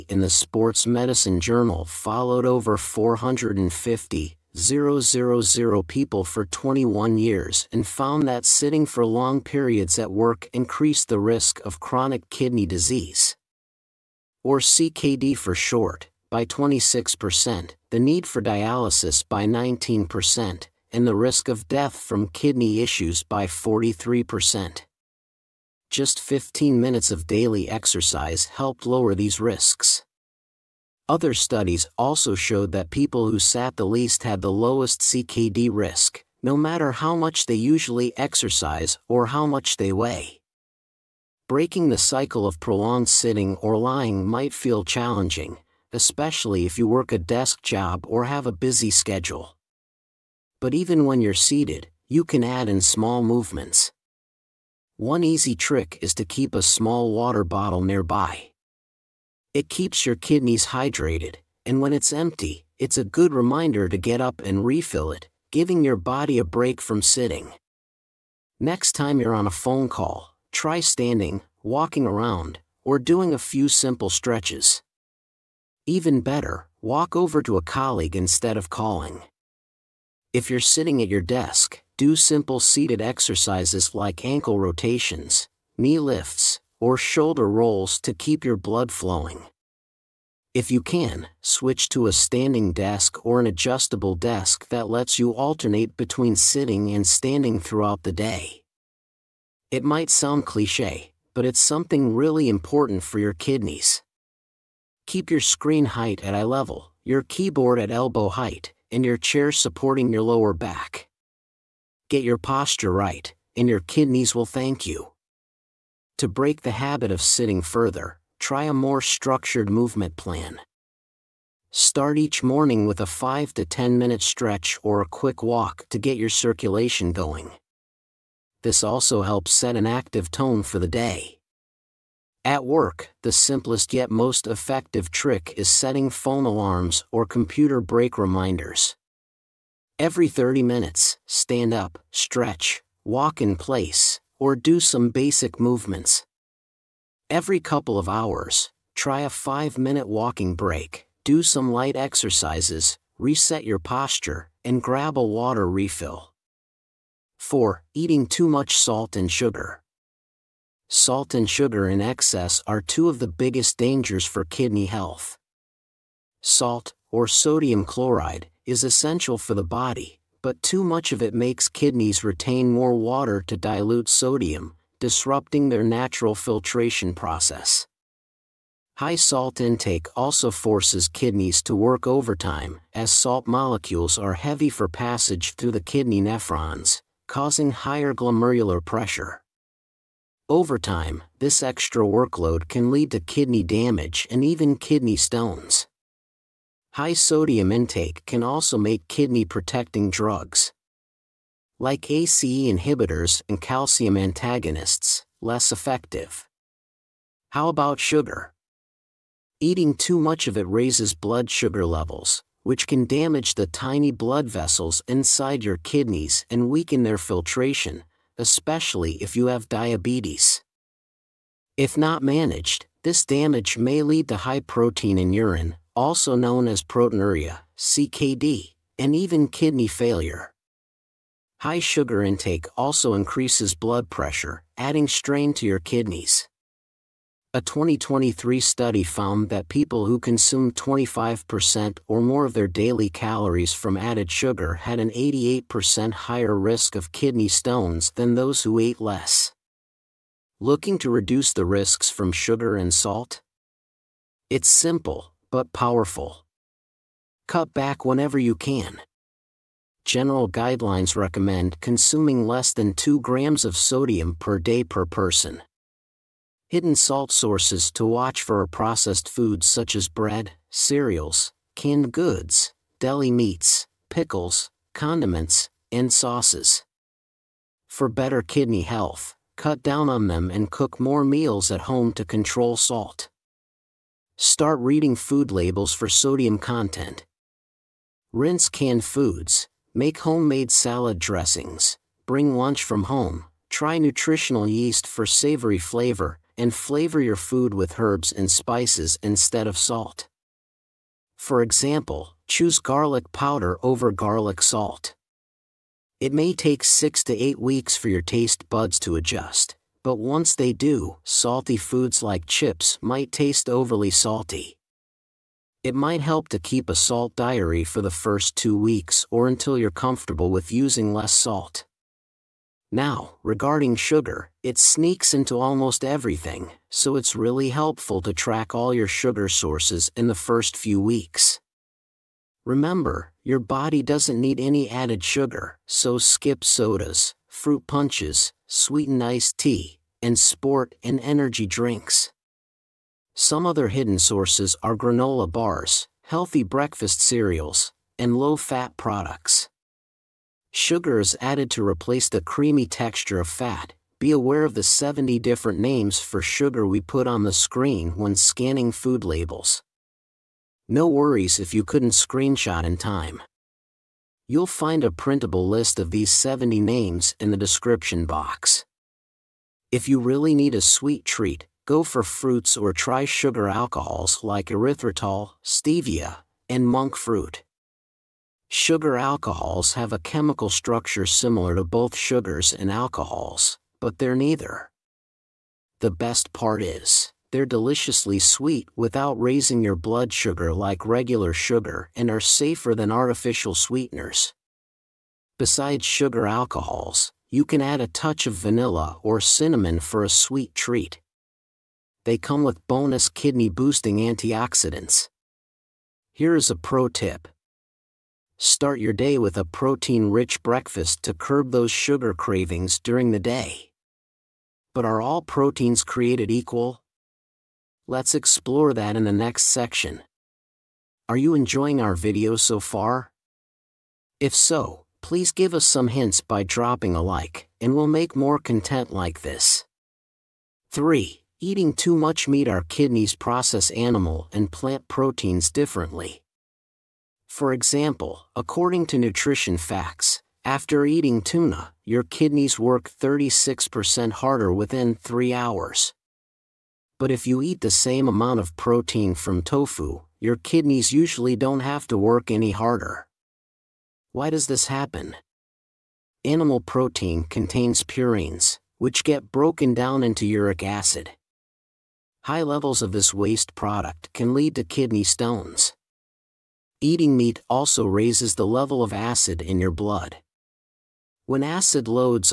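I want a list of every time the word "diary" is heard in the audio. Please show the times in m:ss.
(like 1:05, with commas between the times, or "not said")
5:17.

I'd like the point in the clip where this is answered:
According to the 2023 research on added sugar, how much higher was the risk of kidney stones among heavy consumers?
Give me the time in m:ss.
4:05.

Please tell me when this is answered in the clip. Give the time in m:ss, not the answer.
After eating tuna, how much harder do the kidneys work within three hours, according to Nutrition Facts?
7:23.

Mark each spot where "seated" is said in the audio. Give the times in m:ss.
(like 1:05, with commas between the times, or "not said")
0:51, 1:22.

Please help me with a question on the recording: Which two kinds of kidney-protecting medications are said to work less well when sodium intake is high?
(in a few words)
ACE inhibitors and calcium antagonists.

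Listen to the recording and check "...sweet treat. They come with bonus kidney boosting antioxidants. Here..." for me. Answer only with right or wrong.
right.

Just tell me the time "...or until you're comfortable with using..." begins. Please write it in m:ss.
5:19.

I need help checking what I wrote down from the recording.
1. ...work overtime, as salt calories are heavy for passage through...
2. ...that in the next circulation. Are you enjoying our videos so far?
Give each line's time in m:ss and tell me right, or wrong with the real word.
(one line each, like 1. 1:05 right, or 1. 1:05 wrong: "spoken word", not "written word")
1. 3:01 wrong: "molecules", not "calories"
2. 6:58 wrong: "section", not "circulation".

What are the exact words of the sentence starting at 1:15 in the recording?
Even better, walk over to a colleague instead of calling.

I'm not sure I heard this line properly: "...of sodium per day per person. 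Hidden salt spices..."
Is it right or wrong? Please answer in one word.
wrong.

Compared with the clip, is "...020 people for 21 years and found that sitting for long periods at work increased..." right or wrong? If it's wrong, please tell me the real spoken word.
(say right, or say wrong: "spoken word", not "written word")
wrong: "000", not "020".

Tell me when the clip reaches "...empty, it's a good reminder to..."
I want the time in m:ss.
1:02.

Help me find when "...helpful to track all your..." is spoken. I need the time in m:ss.
5:27.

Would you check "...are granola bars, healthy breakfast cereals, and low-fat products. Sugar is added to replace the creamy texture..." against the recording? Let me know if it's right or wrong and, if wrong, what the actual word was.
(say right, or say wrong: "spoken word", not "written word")
right.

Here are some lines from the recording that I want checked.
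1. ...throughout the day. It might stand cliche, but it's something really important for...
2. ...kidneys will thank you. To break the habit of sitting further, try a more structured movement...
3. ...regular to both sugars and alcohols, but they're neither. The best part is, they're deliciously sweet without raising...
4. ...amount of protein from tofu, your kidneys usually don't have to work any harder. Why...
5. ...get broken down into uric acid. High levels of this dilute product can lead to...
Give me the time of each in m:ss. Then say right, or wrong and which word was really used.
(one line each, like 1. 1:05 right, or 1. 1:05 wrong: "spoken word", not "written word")
1. 1:37 wrong: "sound", not "stand"
2. 1:53 right
3. 6:21 wrong: "similar", not "regular"
4. 7:28 right
5. 7:39 wrong: "waste", not "dilute".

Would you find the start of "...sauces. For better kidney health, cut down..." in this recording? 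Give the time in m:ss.
4:36.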